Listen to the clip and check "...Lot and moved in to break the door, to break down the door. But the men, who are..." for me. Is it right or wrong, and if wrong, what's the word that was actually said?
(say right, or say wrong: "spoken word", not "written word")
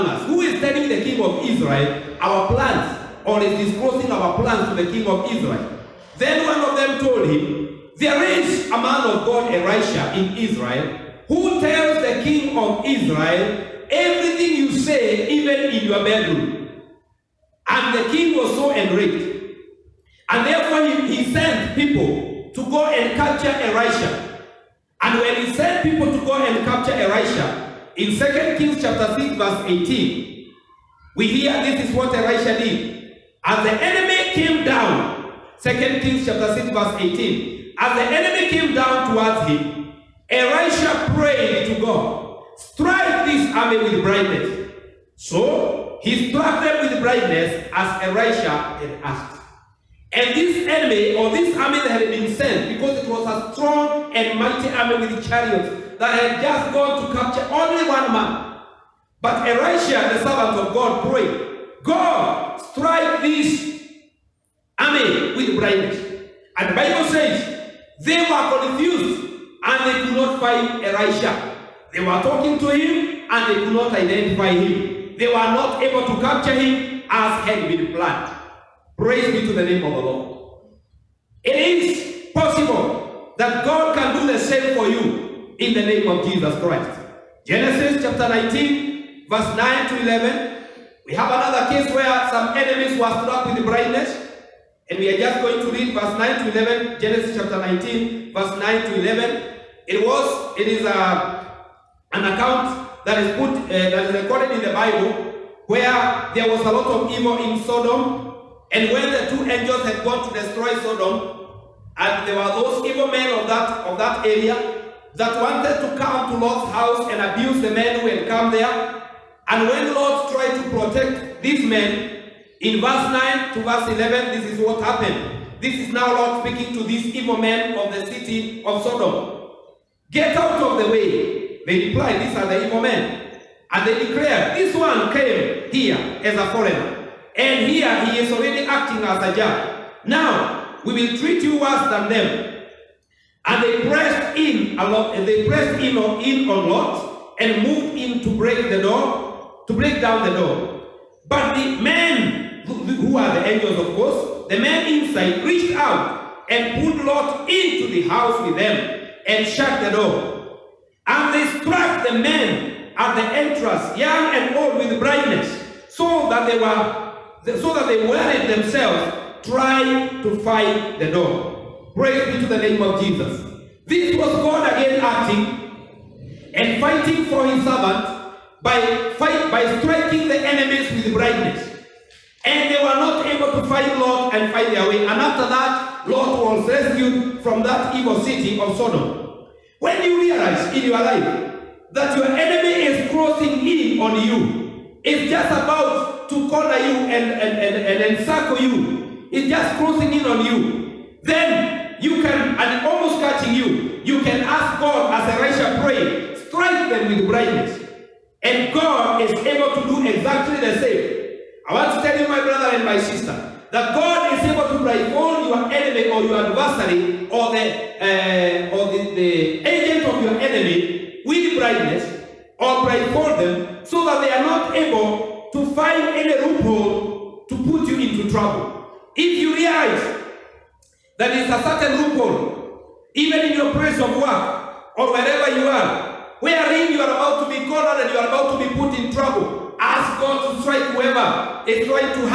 right.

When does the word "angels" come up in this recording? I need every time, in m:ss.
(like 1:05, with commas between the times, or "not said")
1:49, 2:33.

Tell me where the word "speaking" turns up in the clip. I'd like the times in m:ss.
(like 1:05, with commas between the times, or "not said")
2:06.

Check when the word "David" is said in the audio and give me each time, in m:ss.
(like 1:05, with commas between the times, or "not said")
not said.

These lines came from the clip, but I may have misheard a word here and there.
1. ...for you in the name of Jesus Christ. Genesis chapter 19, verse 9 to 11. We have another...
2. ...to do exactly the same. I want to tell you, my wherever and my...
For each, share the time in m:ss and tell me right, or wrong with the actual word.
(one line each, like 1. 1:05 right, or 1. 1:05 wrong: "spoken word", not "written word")
1. 1:24 right
2. 3:29 wrong: "brother", not "wherever".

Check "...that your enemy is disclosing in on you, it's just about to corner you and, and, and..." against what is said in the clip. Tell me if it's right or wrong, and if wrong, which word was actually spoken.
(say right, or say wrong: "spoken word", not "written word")
wrong: "crossing", not "disclosing".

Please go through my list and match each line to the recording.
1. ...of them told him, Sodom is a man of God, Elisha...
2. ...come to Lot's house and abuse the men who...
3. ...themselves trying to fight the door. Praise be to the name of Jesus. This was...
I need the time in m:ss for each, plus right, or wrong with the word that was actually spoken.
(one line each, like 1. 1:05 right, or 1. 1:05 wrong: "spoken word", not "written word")
1. 0:06 wrong: "There", not "Sodom"
2. 1:55 right
3. 2:48 right.